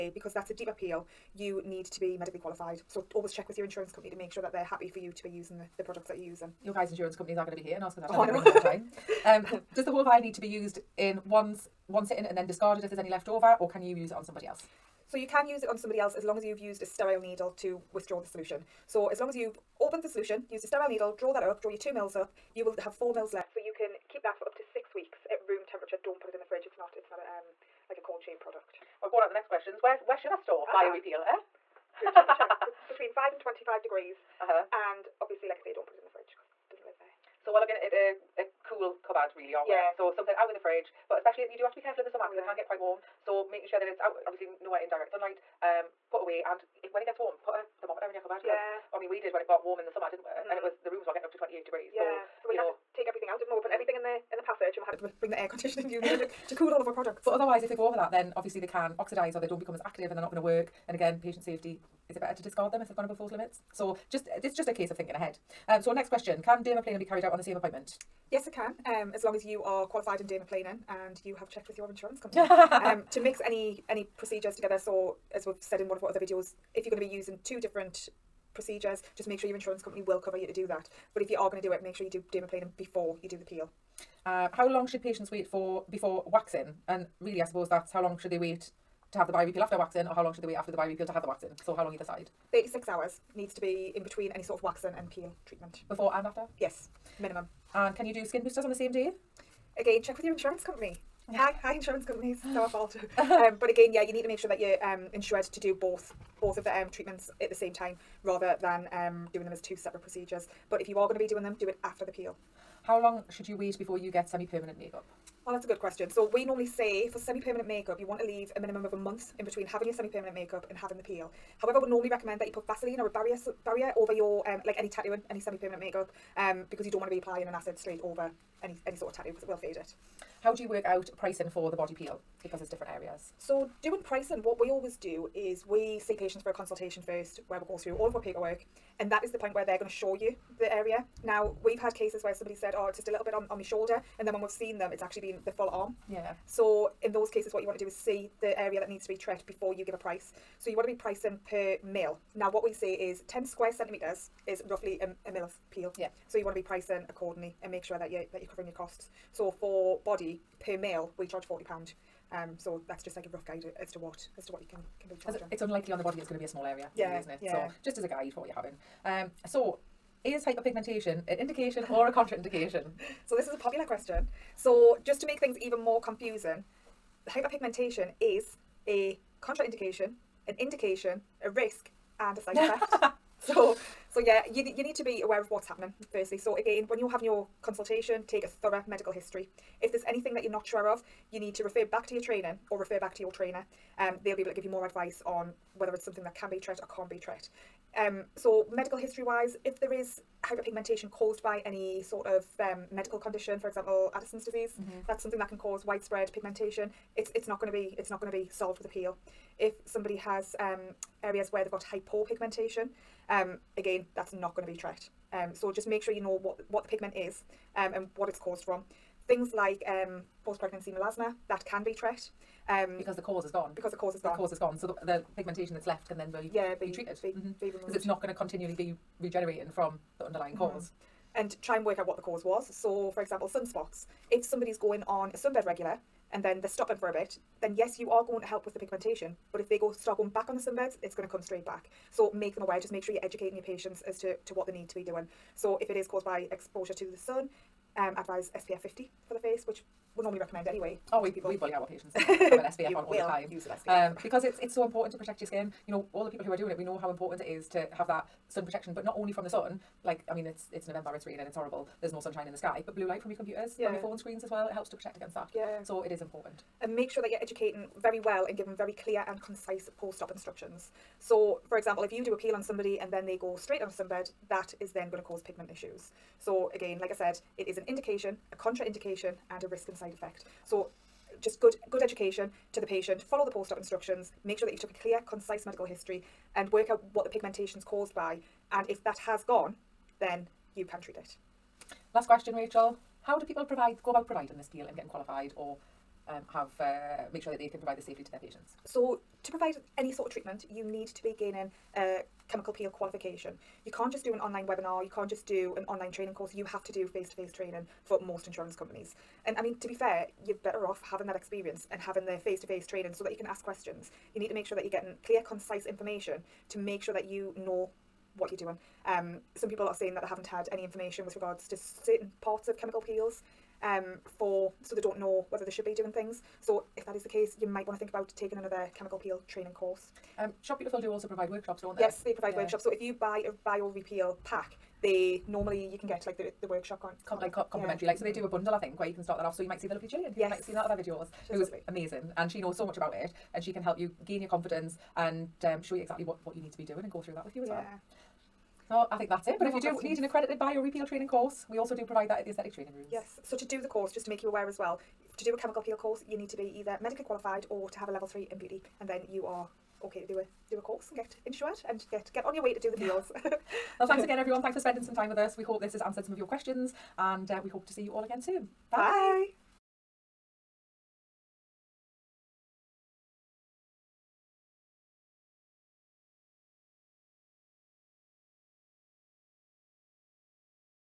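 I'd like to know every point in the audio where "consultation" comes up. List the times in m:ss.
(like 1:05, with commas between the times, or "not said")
2:16, 3:07.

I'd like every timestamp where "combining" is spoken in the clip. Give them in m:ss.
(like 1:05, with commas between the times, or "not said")
not said.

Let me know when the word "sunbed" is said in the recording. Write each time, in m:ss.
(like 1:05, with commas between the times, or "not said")
3:55, 4:00, 4:33.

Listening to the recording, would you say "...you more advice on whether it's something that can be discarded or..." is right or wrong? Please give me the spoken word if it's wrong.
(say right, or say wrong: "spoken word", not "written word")
wrong: "treated", not "discarded".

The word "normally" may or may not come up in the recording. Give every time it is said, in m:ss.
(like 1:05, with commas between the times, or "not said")
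1:56, 2:01, 4:10, 5:35.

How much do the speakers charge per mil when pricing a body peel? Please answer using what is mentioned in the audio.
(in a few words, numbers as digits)
£40.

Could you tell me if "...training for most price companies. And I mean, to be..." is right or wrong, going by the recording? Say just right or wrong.
wrong.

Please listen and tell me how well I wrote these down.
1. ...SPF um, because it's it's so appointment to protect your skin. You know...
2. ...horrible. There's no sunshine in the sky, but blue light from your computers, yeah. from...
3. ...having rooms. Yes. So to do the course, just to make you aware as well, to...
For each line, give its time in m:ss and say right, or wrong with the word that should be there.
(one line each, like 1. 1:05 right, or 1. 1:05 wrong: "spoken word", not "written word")
1. 4:13 wrong: "important", not "appointment"
2. 4:21 right
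3. 5:52 wrong: "training", not "having".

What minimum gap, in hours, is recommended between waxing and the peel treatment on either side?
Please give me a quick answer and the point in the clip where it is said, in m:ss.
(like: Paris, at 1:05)
36 hours, at 1:32.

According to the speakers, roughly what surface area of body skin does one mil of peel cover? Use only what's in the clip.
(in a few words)
10 square centimetres.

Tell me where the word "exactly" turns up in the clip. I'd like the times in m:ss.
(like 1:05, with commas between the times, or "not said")
5:46.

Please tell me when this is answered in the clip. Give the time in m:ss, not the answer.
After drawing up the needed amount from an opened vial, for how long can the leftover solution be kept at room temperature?
0:24.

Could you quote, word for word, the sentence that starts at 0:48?
I mean we did when it got warm in the summer, didn't we?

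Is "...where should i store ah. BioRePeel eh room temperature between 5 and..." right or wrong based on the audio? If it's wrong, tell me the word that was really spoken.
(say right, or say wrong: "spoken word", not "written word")
right.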